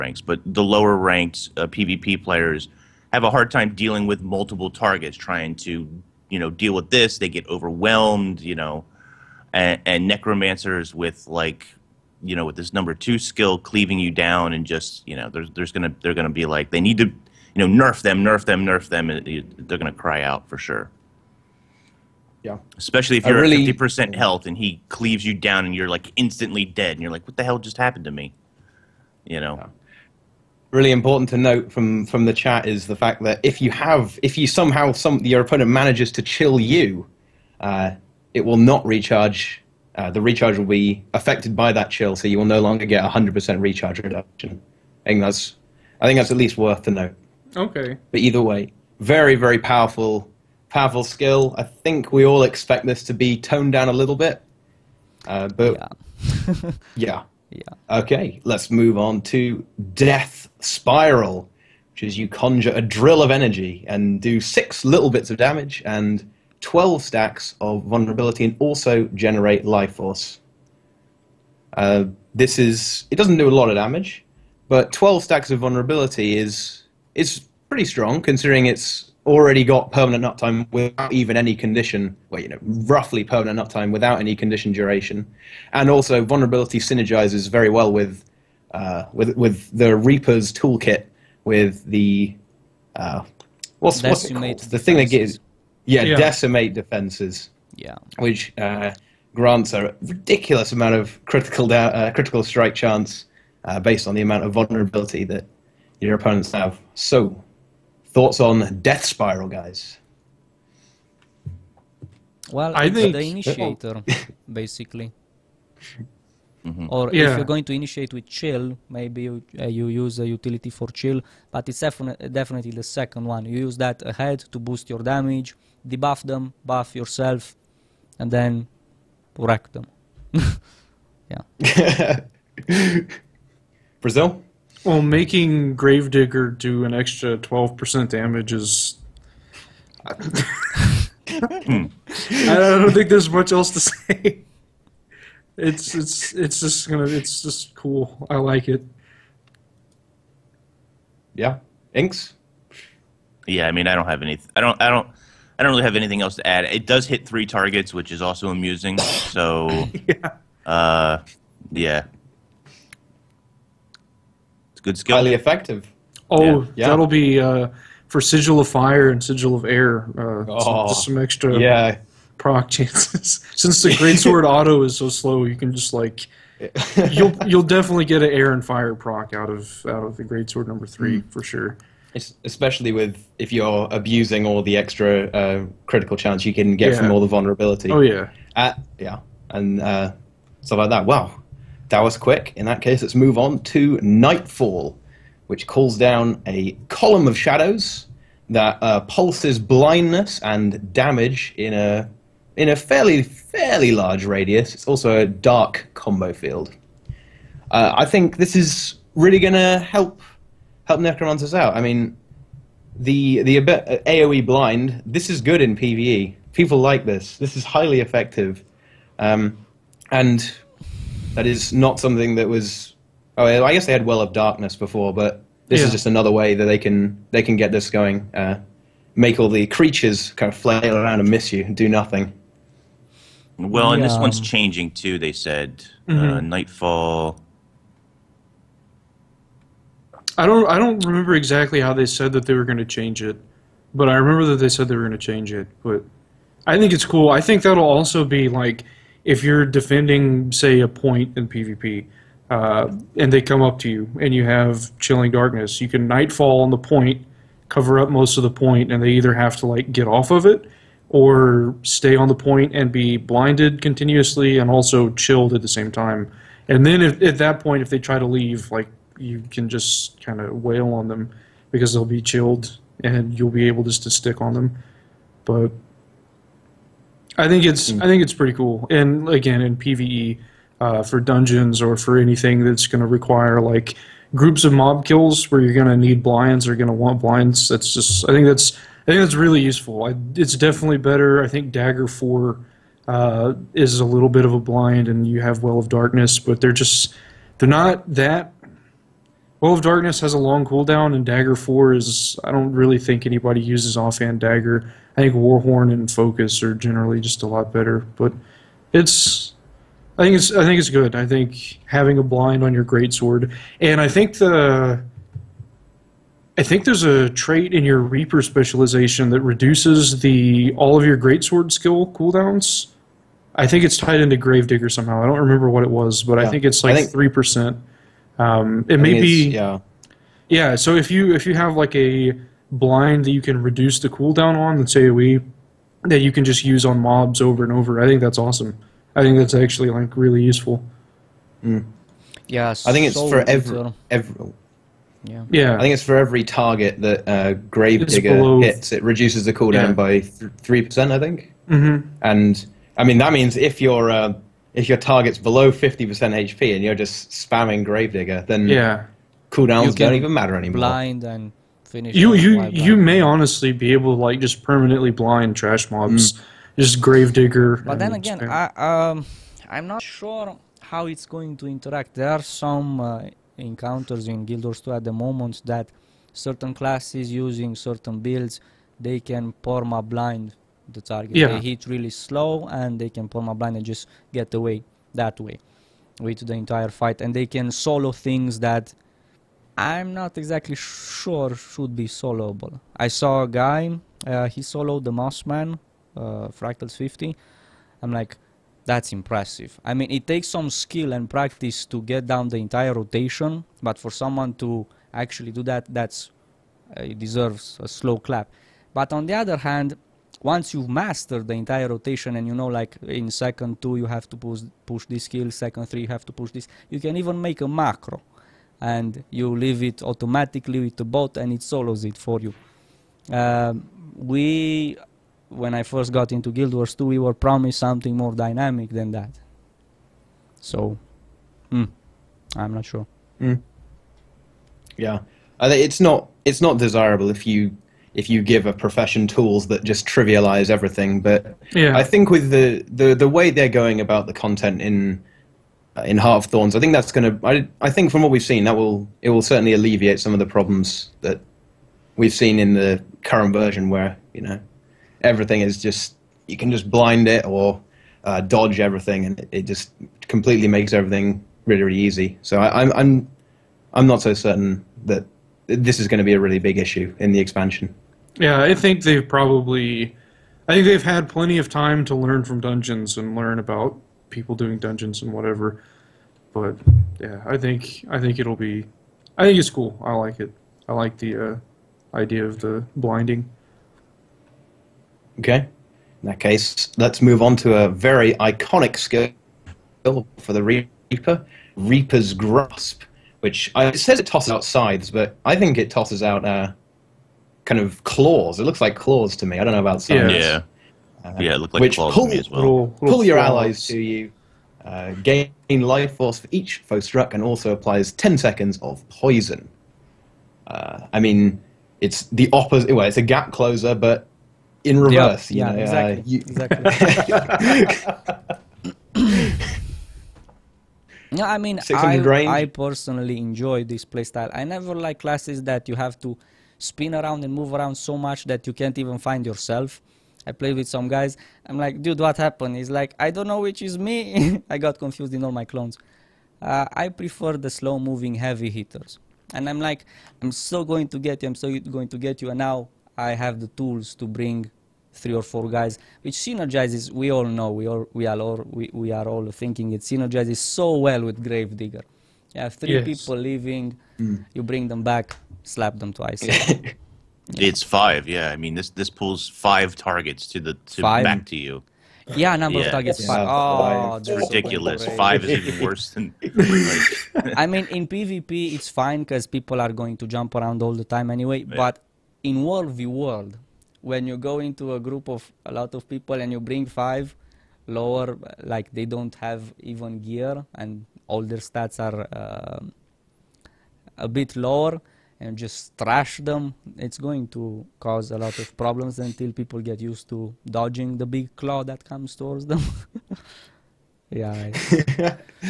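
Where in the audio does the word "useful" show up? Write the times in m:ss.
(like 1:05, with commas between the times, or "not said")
4:49, 5:40.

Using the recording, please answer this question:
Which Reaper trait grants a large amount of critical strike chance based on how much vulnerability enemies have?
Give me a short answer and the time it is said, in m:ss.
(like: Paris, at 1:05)
Decimate Defenses, at 1:36.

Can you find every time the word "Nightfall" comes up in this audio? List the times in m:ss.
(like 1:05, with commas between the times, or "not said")
3:14, 3:56, 4:16.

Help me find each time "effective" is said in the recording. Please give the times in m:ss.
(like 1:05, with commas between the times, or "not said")
2:45, 3:37.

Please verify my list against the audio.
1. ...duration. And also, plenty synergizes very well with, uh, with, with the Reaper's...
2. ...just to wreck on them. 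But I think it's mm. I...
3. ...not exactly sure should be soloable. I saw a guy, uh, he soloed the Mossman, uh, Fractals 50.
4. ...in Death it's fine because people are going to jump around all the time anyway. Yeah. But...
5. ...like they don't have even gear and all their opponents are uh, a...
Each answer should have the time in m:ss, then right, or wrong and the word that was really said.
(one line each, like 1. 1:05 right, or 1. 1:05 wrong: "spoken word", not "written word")
1. 1:24 wrong: "vulnerability", not "plenty"
2. 4:33 wrong: "stick", not "wreck"
3. 6:30 right
4. 9:27 wrong: "PvP", not "Death"
5. 9:38 wrong: "stats", not "opponents".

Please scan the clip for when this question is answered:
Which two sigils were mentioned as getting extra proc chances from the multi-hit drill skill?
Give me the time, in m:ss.
2:48.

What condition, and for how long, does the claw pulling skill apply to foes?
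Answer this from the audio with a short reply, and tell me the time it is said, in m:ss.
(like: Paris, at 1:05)
10 seconds of poison, at 8:28.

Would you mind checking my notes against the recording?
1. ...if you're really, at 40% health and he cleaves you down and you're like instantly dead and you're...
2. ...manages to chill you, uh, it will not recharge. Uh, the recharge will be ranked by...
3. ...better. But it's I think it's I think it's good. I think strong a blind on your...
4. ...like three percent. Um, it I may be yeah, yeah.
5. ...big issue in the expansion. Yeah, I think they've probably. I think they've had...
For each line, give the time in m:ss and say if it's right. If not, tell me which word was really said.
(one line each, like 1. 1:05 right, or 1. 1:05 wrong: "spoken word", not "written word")
1. 0:23 wrong: "50", not "40"
2. 0:35 wrong: "affected", not "ranked"
3. 5:07 wrong: "having", not "strong"
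4. 5:26 right
5. 7:46 right.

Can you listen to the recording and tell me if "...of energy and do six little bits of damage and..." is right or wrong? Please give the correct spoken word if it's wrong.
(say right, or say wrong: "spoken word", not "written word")
right.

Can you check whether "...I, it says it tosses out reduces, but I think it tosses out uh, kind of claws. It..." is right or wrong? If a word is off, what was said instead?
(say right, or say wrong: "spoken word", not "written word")
wrong: "scythes", not "reduces".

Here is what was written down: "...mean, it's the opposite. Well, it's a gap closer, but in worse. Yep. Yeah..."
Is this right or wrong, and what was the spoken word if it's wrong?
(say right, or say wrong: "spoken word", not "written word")
wrong: "reverse", not "worse".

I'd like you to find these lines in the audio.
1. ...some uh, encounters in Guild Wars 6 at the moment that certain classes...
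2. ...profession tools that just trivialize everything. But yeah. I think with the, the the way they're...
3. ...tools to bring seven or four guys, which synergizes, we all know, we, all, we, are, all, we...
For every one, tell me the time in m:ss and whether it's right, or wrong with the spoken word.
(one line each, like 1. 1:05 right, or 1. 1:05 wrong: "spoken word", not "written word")
1. 6:12 wrong: "2", not "6"
2. 7:18 right
3. 9:03 wrong: "three", not "seven".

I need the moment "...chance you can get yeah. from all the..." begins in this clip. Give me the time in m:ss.
3:06.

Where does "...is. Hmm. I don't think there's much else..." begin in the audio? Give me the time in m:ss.
2:18.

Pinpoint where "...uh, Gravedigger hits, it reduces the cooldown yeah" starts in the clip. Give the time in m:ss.
5:47.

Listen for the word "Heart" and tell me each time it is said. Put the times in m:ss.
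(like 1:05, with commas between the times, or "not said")
7:26.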